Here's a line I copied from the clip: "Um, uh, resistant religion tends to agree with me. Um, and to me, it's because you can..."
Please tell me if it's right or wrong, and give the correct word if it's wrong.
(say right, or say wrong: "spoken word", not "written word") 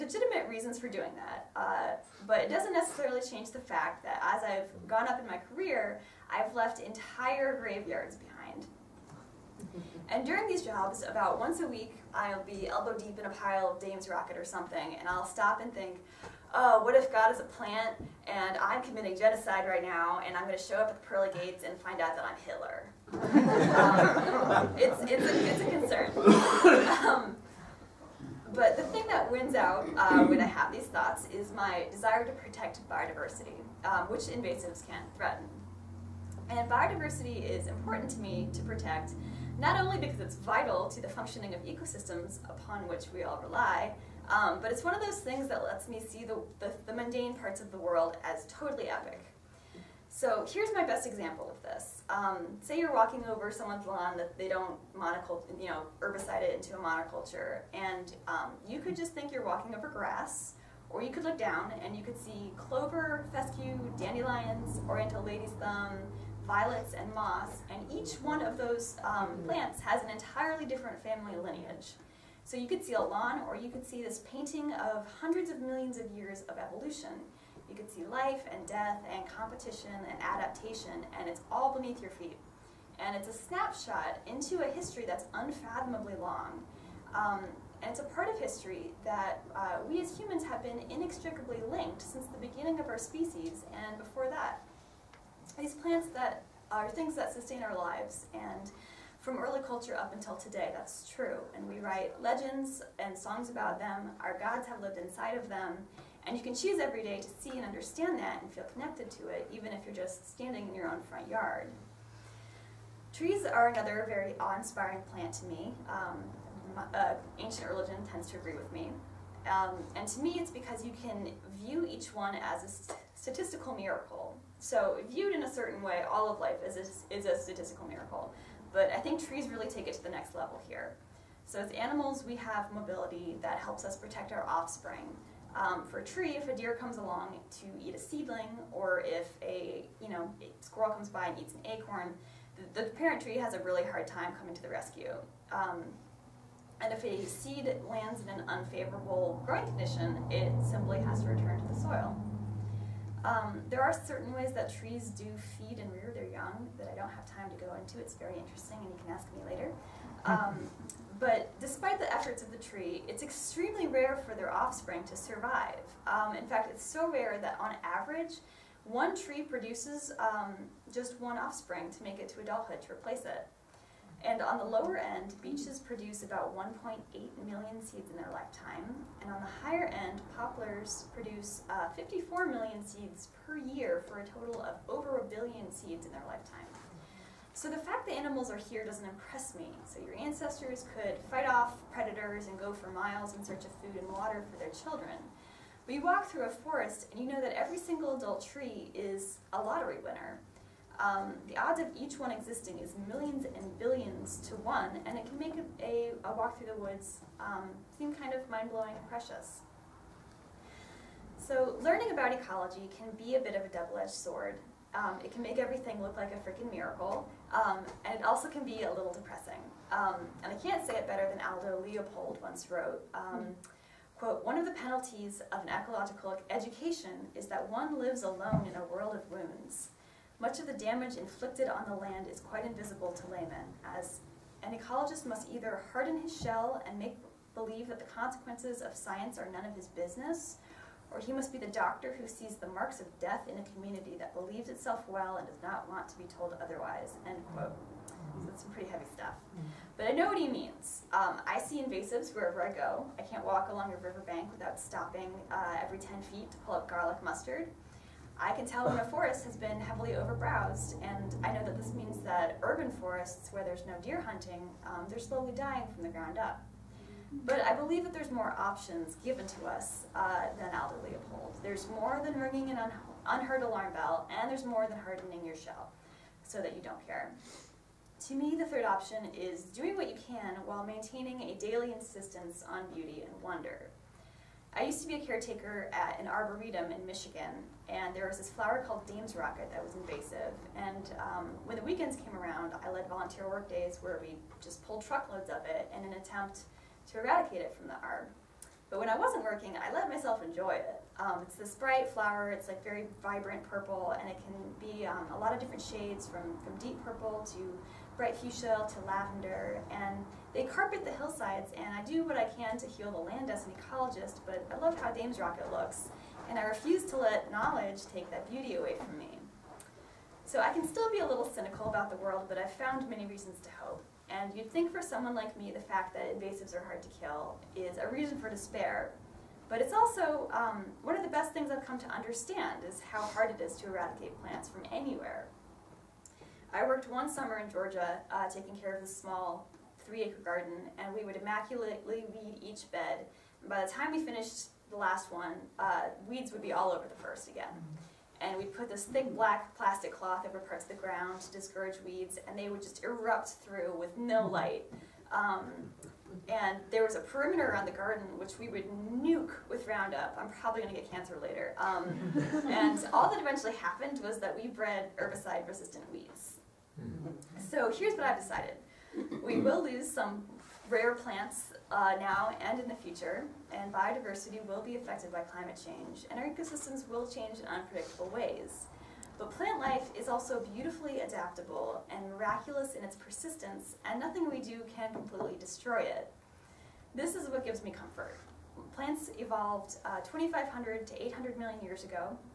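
wrong: "ancient", not "resistant".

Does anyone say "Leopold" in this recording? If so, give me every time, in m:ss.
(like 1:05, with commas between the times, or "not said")
3:41, 4:31.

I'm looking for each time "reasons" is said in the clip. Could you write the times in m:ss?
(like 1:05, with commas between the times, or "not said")
0:00, 5:23, 5:28.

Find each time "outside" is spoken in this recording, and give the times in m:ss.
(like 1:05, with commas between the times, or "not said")
not said.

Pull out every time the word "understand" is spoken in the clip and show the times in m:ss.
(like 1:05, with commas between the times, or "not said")
1:47, 5:32.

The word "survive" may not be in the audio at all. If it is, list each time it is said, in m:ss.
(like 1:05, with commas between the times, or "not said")
2:45.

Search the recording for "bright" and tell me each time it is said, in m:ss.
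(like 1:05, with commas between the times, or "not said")
5:01, 5:08.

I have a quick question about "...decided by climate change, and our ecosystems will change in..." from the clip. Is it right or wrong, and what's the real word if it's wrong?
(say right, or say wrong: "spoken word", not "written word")
wrong: "affected", not "decided".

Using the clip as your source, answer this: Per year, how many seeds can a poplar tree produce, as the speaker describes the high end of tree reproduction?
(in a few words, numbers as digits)
54 million.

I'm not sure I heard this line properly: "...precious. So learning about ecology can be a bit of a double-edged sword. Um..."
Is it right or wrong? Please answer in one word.
right.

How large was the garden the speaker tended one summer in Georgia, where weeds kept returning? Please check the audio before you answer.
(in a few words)
3 acres.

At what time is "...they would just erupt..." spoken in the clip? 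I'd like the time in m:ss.
5:52.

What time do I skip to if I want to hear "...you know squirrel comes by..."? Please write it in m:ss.
2:20.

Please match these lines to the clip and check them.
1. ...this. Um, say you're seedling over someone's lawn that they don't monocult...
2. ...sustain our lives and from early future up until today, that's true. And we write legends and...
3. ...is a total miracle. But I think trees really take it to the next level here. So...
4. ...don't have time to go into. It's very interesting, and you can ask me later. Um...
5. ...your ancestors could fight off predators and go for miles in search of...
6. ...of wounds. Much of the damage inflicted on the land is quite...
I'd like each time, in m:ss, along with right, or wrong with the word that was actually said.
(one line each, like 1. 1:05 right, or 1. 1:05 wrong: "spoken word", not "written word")
1. 0:51 wrong: "walking", not "seedling"
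2. 1:37 wrong: "culture", not "future"
3. 2:07 wrong: "statistical", not "total"
4. 2:36 right
5. 3:10 right
6. 3:49 right.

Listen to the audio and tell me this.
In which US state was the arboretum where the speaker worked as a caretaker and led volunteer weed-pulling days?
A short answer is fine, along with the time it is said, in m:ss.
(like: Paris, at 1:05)
Michigan, at 4:47.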